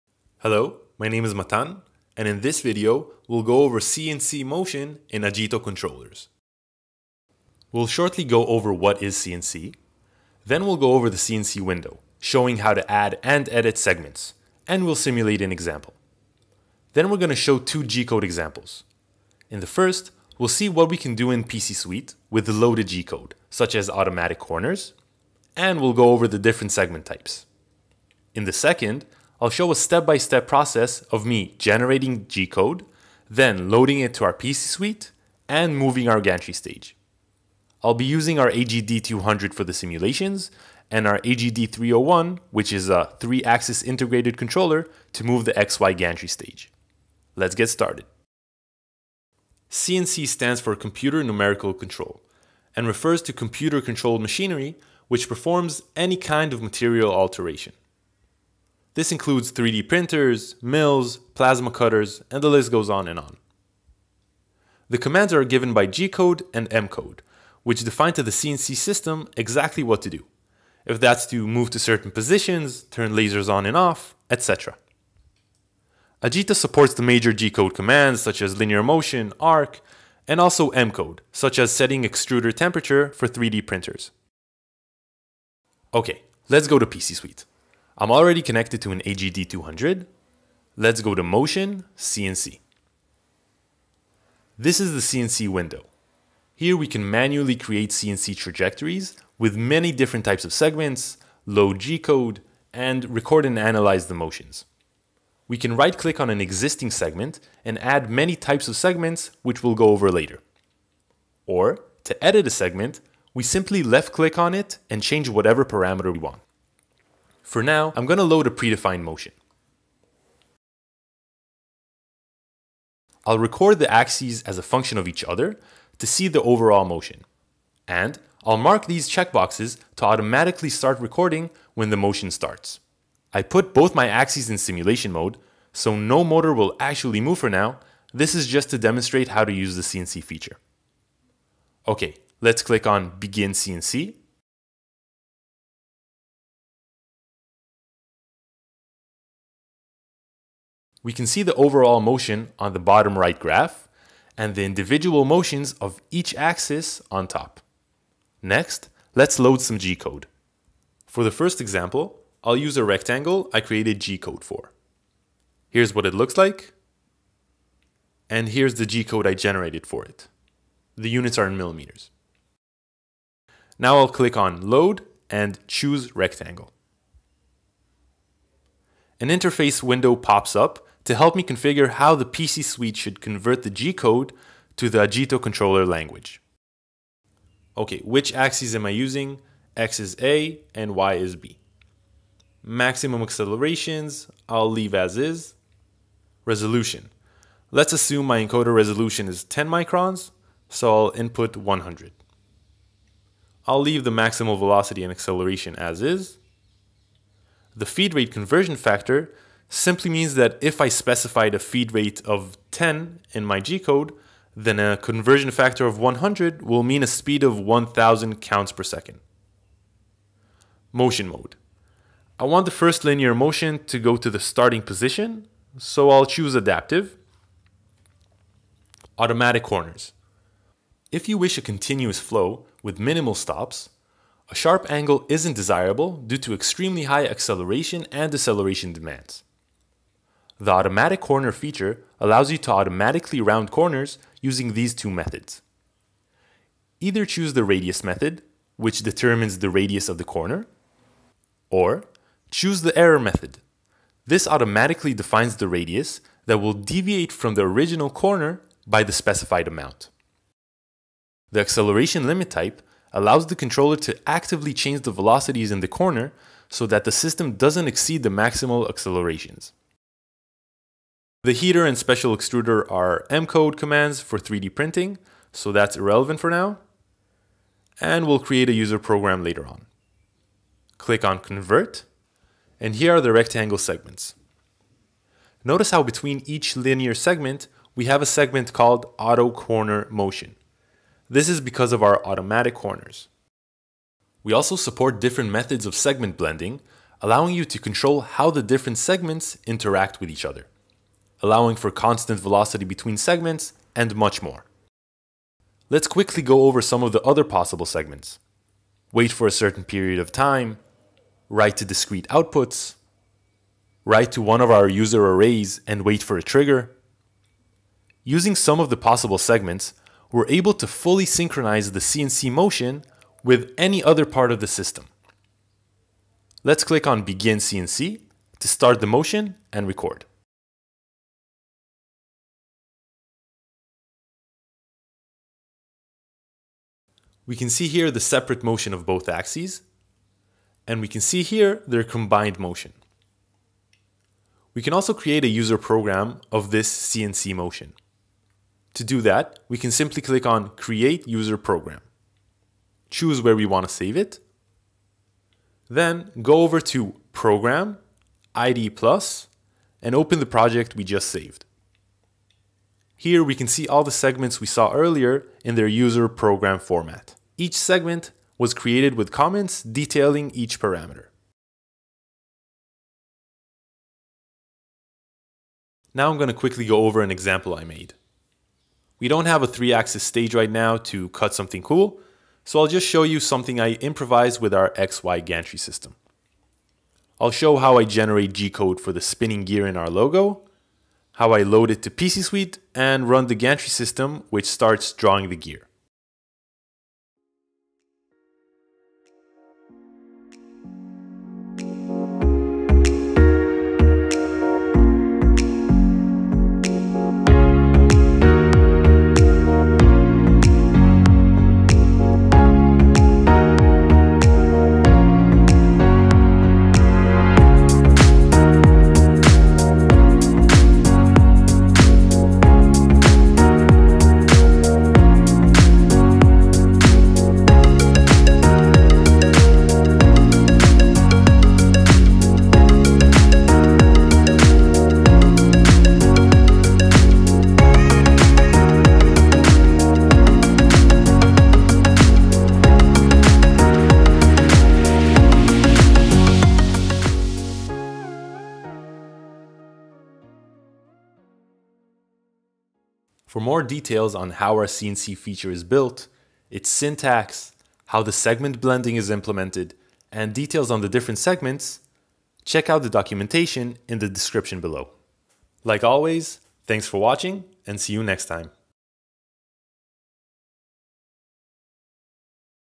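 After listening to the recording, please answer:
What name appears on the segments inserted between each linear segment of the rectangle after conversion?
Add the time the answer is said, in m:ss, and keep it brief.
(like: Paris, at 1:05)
Auto Corner Motion, at 4:49.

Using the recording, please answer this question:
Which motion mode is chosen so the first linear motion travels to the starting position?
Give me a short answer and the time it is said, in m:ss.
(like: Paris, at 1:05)
adaptive, at 3:46.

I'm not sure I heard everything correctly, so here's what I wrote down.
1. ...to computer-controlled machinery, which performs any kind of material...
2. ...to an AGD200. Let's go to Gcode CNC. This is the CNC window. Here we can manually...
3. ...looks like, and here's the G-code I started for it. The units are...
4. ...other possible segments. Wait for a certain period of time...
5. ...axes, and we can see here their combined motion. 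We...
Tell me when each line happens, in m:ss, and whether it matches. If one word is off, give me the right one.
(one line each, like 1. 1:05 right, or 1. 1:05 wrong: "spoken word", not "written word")
1. 0:53 right
2. 1:28 wrong: "Motion", not "Gcode"
3. 2:46 wrong: "generated", not "started"
4. 5:07 right
5. 5:39 right.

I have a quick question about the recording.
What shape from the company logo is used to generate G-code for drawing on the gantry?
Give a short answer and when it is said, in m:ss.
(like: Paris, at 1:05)
spinning gear, at 6:29.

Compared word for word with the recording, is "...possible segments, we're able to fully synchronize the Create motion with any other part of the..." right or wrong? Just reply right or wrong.
wrong.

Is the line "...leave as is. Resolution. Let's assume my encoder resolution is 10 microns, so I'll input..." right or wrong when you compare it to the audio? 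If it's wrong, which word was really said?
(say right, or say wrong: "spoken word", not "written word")
right.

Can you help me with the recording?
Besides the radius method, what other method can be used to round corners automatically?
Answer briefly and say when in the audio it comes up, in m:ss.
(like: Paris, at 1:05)
error method, at 4:12.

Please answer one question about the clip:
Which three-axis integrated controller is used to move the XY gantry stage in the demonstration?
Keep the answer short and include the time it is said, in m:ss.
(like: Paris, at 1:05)
AGD301, at 0:41.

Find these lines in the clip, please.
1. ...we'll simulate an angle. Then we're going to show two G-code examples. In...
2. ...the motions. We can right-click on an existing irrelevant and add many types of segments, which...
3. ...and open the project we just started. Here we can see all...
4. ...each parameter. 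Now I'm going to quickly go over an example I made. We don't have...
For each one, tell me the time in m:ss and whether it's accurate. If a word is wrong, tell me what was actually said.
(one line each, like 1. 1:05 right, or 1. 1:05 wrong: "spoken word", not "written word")
1. 0:14 wrong: "example", not "angle"
2. 1:44 wrong: "segment", not "irrelevant"
3. 6:00 wrong: "saved", not "started"
4. 6:10 right.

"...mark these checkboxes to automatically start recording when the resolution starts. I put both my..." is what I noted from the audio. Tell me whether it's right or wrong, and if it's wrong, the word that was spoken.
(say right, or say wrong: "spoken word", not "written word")
wrong: "motion", not "resolution".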